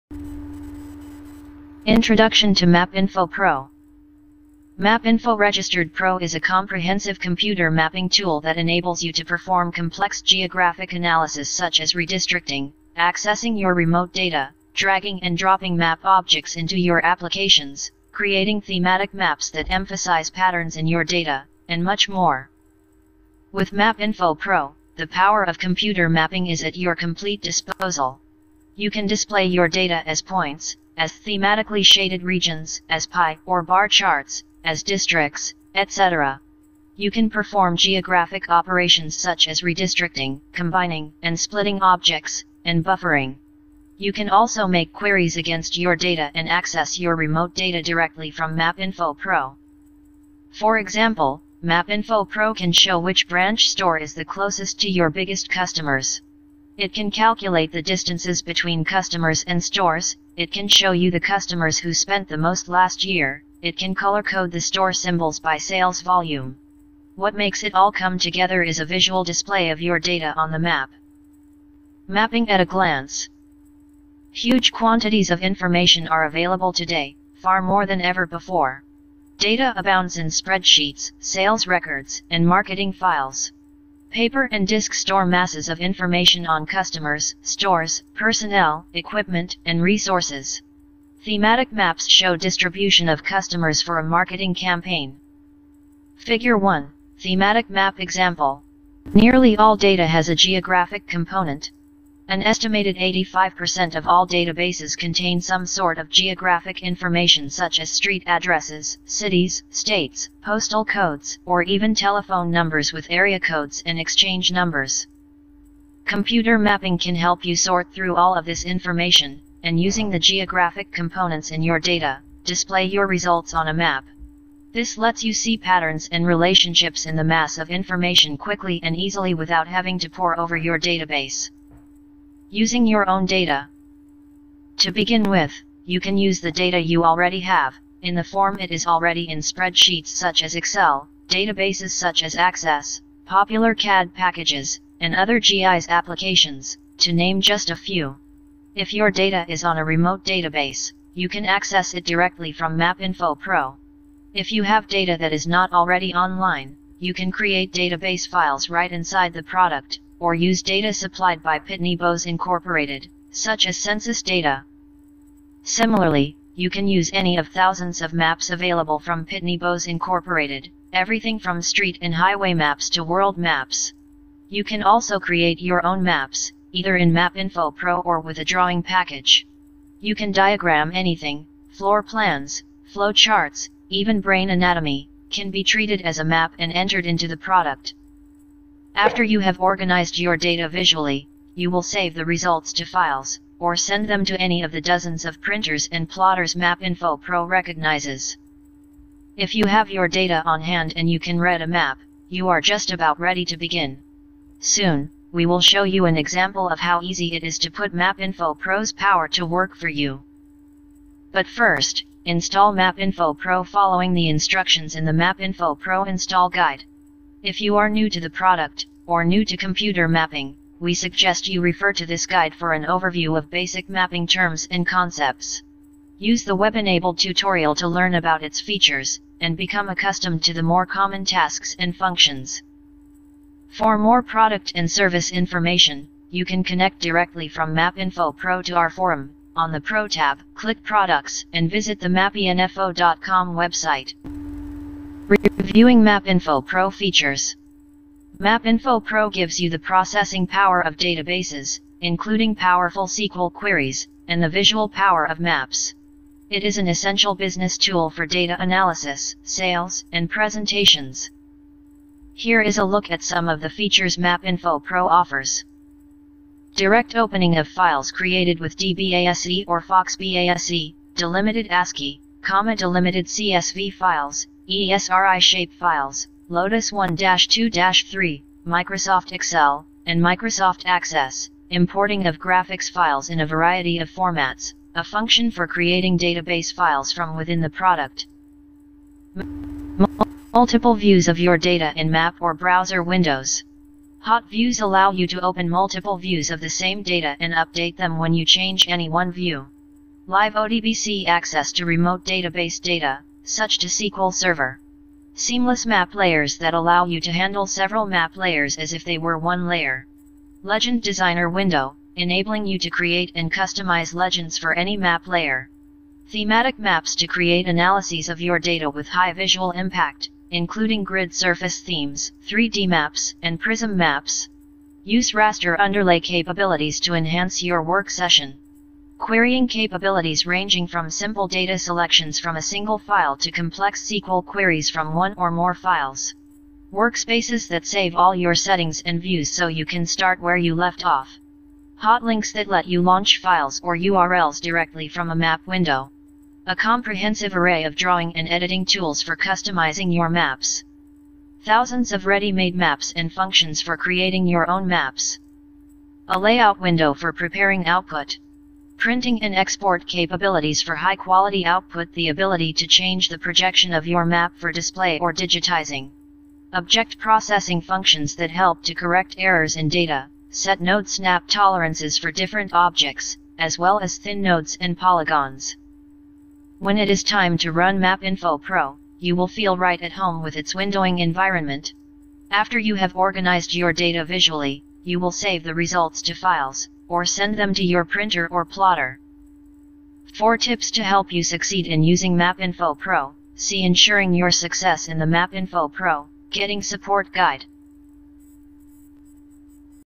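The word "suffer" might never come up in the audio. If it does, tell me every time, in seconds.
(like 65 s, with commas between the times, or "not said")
not said.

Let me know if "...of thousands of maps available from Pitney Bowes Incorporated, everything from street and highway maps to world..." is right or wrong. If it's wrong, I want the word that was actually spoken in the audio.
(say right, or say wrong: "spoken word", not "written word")
right.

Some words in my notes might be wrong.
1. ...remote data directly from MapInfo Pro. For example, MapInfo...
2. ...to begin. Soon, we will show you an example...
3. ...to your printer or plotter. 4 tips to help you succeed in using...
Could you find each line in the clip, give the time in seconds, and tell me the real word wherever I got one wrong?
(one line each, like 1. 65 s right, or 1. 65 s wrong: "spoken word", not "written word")
1. 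47 s right
2. 203 s right
3. 387 s right.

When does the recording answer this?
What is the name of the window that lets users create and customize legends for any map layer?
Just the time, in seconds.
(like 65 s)
310 s.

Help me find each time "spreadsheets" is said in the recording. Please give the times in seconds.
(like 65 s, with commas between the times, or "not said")
80 s, 139 s.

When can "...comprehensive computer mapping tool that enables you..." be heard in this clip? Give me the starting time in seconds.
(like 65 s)
6 s.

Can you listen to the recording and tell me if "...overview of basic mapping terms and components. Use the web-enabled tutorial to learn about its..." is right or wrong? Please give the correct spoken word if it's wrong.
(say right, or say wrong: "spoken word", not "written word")
wrong: "concepts", not "components".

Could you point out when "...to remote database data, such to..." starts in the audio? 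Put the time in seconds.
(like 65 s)
301 s.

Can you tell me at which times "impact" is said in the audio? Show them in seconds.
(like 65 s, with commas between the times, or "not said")
319 s.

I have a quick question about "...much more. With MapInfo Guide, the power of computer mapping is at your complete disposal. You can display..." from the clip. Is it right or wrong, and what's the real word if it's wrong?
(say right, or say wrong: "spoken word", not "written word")
wrong: "Pro", not "Guide".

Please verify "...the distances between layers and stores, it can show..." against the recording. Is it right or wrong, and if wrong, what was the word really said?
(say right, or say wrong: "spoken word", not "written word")
wrong: "customers", not "layers".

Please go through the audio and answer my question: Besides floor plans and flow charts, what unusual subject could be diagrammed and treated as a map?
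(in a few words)
Brain anatomy.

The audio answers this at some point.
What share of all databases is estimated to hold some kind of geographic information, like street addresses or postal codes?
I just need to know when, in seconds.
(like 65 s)
102 s.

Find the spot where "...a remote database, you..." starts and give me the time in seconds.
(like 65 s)
149 s.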